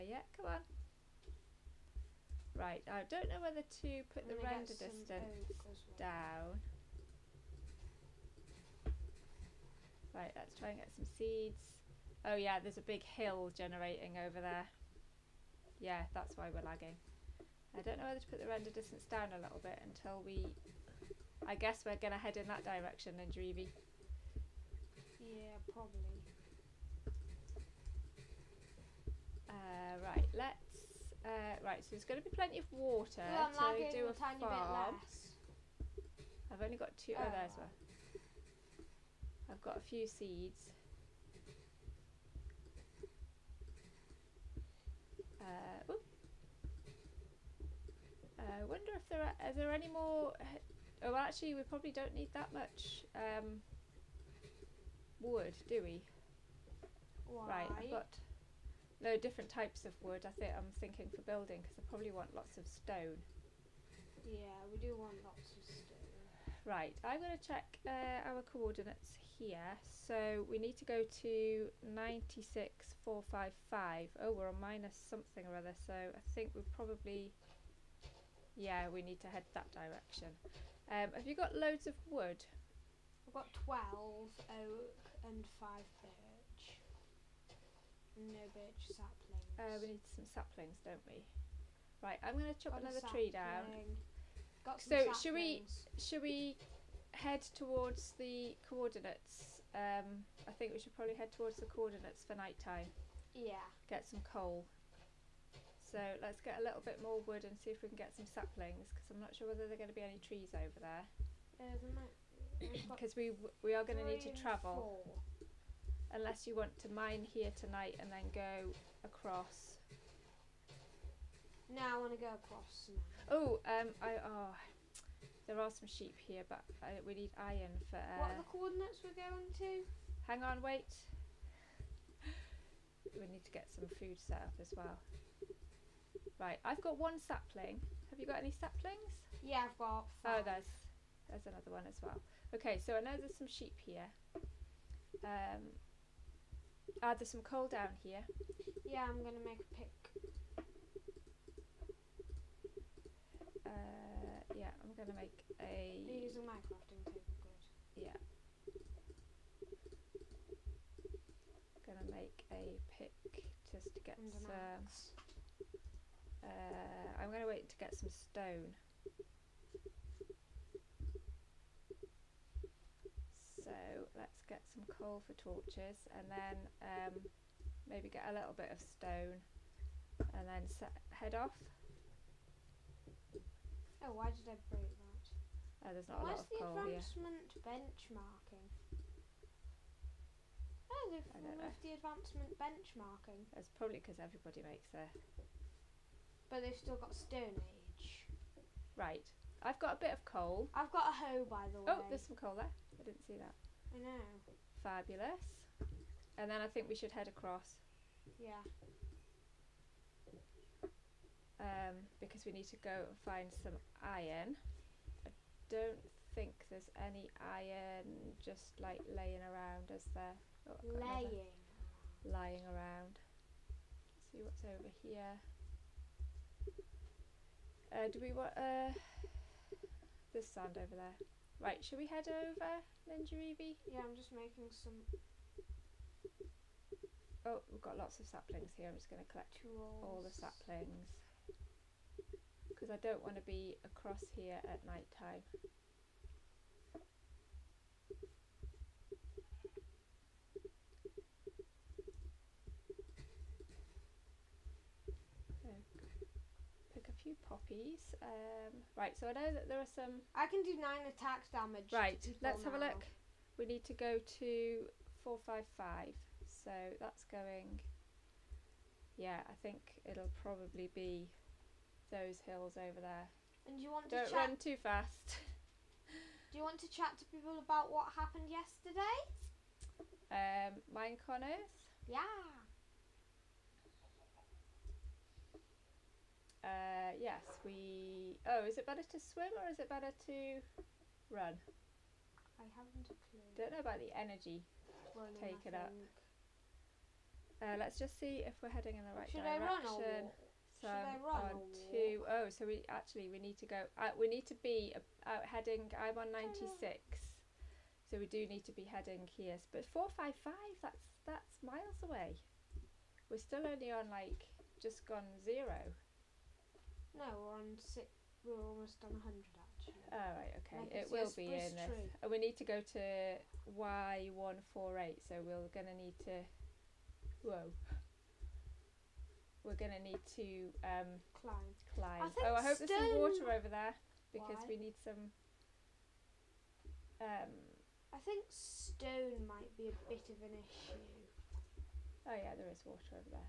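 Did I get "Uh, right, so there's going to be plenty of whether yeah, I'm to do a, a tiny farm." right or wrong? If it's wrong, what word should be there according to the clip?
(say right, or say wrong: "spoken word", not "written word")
wrong: "water", not "whether".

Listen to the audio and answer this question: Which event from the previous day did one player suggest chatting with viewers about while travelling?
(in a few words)
Minecon Earth.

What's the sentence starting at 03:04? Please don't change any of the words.
Oh, why did I break that?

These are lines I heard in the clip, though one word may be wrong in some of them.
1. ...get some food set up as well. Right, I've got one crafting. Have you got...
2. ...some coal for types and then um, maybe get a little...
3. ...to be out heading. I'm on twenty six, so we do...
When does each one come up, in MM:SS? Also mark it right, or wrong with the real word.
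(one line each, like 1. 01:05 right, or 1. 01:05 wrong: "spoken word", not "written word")
1. 02:13 wrong: "sapling", not "crafting"
2. 02:54 wrong: "torches", not "types"
3. 05:04 wrong: "ninety", not "twenty".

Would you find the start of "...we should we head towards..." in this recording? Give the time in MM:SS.
01:35.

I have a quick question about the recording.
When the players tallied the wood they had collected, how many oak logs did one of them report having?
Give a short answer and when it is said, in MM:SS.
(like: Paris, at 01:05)
12, at 01:23.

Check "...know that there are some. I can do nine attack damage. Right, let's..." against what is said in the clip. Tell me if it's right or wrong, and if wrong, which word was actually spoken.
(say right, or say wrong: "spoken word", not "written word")
right.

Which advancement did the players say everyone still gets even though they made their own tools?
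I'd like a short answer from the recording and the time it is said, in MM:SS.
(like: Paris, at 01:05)
Stone Age, at 03:17.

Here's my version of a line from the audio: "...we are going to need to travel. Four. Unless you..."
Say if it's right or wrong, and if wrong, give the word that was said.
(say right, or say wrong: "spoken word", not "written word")
right.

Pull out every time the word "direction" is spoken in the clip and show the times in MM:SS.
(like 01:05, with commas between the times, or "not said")
00:22, 01:19, 04:59.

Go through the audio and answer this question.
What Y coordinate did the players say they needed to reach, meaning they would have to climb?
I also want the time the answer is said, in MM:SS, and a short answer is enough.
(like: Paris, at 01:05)
148, at 05:23.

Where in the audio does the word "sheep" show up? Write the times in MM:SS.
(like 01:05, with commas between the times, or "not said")
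02:05, 02:23.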